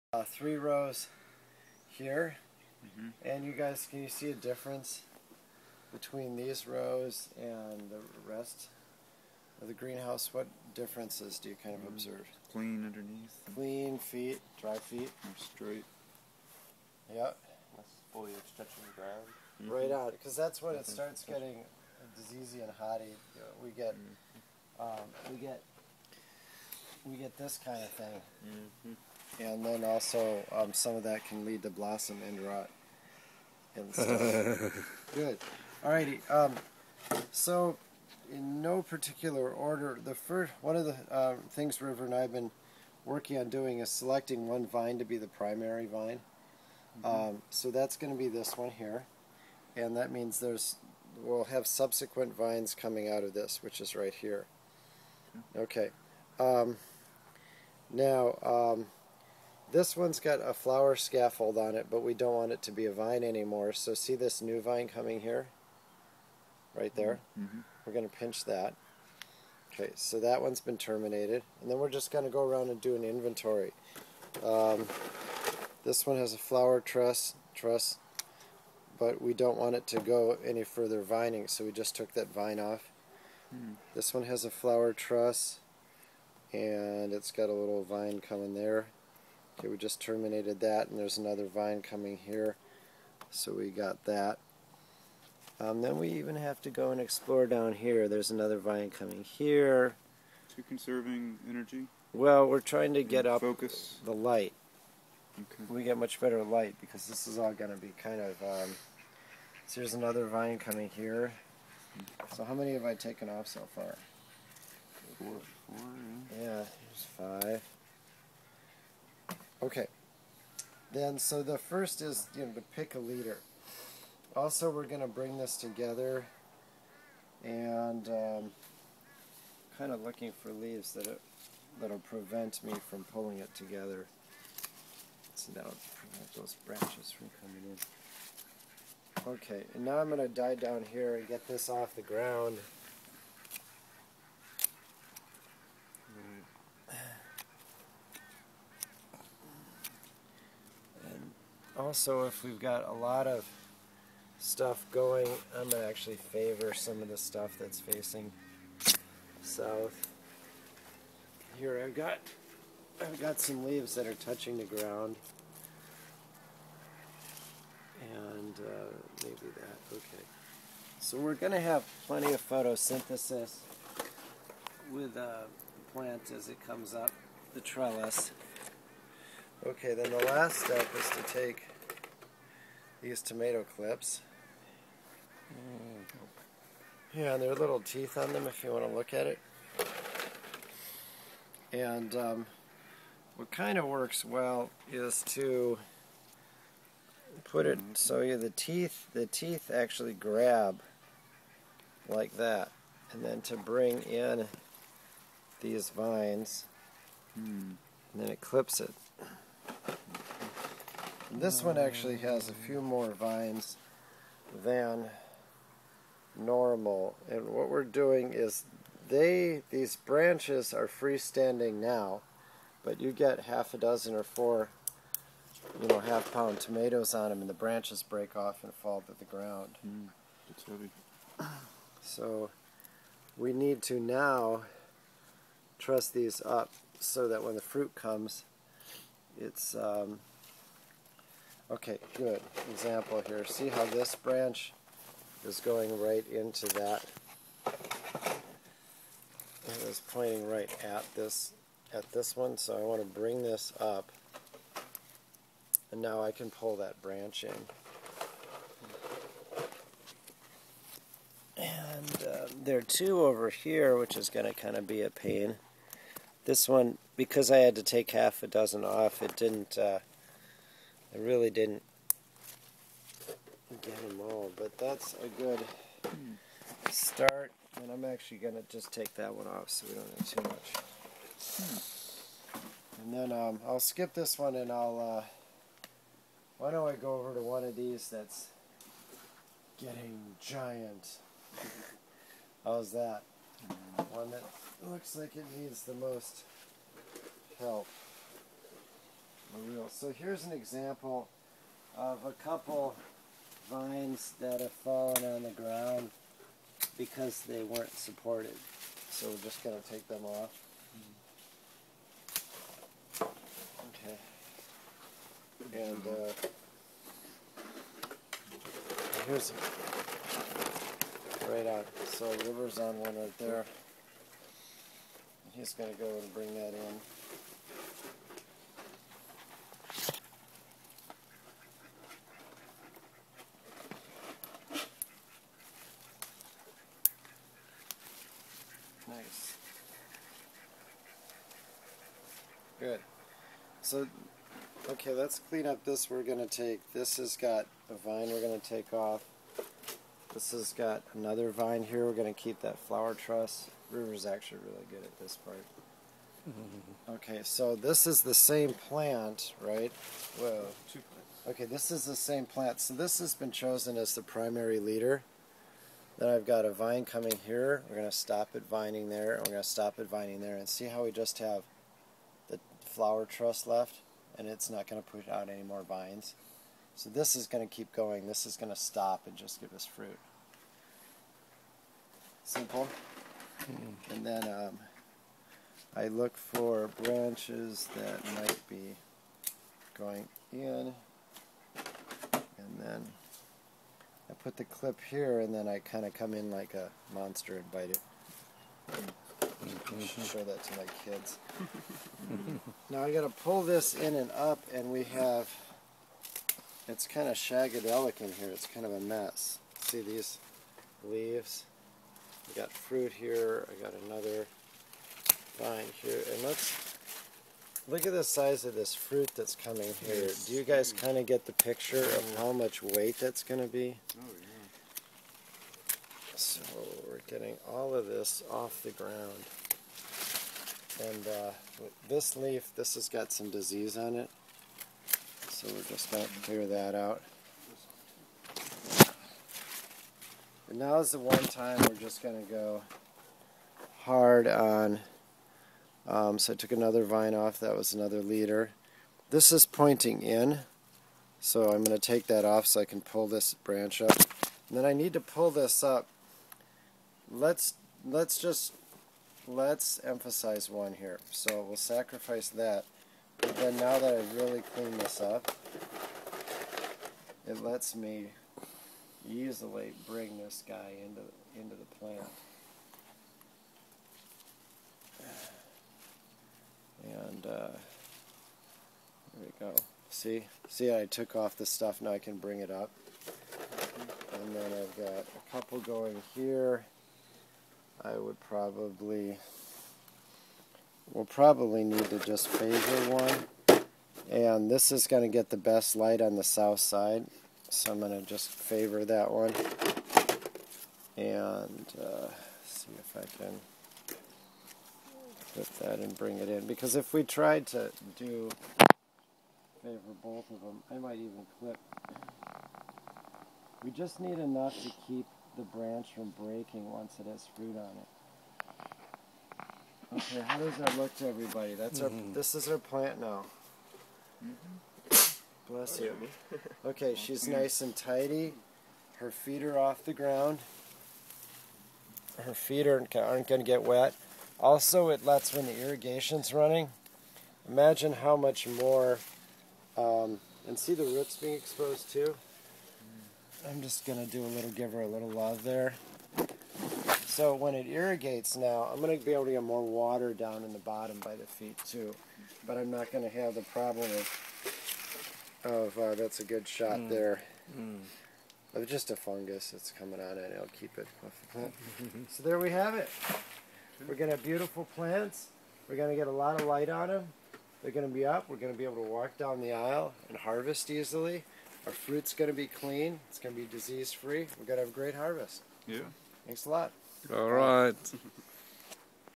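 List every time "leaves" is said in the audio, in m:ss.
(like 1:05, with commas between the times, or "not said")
2:10, 2:43, 6:51.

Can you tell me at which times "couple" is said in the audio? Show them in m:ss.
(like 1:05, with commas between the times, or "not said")
5:02, 8:05.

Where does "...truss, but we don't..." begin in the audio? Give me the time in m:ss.
1:17.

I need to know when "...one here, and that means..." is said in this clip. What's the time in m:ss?
0:48.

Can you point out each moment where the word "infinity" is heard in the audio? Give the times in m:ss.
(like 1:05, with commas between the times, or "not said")
not said.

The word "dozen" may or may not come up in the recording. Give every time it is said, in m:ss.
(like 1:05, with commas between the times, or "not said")
3:43, 4:28.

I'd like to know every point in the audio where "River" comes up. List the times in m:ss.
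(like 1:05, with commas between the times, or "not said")
0:41, 5:22, 5:53.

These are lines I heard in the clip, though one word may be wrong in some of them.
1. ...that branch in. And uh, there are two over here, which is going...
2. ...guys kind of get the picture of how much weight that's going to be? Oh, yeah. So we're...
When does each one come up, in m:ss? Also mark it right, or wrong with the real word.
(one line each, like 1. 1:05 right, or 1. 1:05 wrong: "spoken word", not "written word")
1. 4:16 right
2. 7:00 right.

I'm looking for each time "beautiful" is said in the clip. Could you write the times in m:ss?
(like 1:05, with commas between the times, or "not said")
9:24.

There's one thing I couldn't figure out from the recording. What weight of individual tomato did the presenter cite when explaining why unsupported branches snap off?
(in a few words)
half pound.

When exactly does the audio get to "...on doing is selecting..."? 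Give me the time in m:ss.
0:43.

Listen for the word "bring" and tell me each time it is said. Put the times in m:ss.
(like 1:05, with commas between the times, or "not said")
2:05, 3:23, 4:13, 5:26, 7:50, 8:02, 8:26.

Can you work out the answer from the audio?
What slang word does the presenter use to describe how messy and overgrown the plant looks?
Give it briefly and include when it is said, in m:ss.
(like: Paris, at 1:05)
shagadelic, at 6:47.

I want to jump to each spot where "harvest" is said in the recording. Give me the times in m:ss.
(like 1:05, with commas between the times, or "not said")
9:30, 9:35.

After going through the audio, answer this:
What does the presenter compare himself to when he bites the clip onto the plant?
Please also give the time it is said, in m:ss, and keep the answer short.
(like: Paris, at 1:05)
monster, at 6:37.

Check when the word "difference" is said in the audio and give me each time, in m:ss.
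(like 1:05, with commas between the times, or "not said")
0:04, 0:10.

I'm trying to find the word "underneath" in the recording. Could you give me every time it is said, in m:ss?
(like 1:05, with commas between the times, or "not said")
0:12.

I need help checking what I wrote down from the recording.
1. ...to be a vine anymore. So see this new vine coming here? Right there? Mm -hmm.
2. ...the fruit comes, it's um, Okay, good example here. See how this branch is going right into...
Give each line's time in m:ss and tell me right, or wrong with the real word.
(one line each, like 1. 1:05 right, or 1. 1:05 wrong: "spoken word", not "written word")
1. 1:02 right
2. 3:57 right.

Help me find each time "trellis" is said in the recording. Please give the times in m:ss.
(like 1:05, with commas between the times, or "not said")
2:57.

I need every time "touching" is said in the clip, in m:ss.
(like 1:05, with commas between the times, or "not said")
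0:18, 2:44.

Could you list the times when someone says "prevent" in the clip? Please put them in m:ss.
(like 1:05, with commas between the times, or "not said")
2:11, 2:15.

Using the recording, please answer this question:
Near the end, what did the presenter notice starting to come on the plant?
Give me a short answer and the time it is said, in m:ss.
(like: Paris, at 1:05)
fungus, at 9:19.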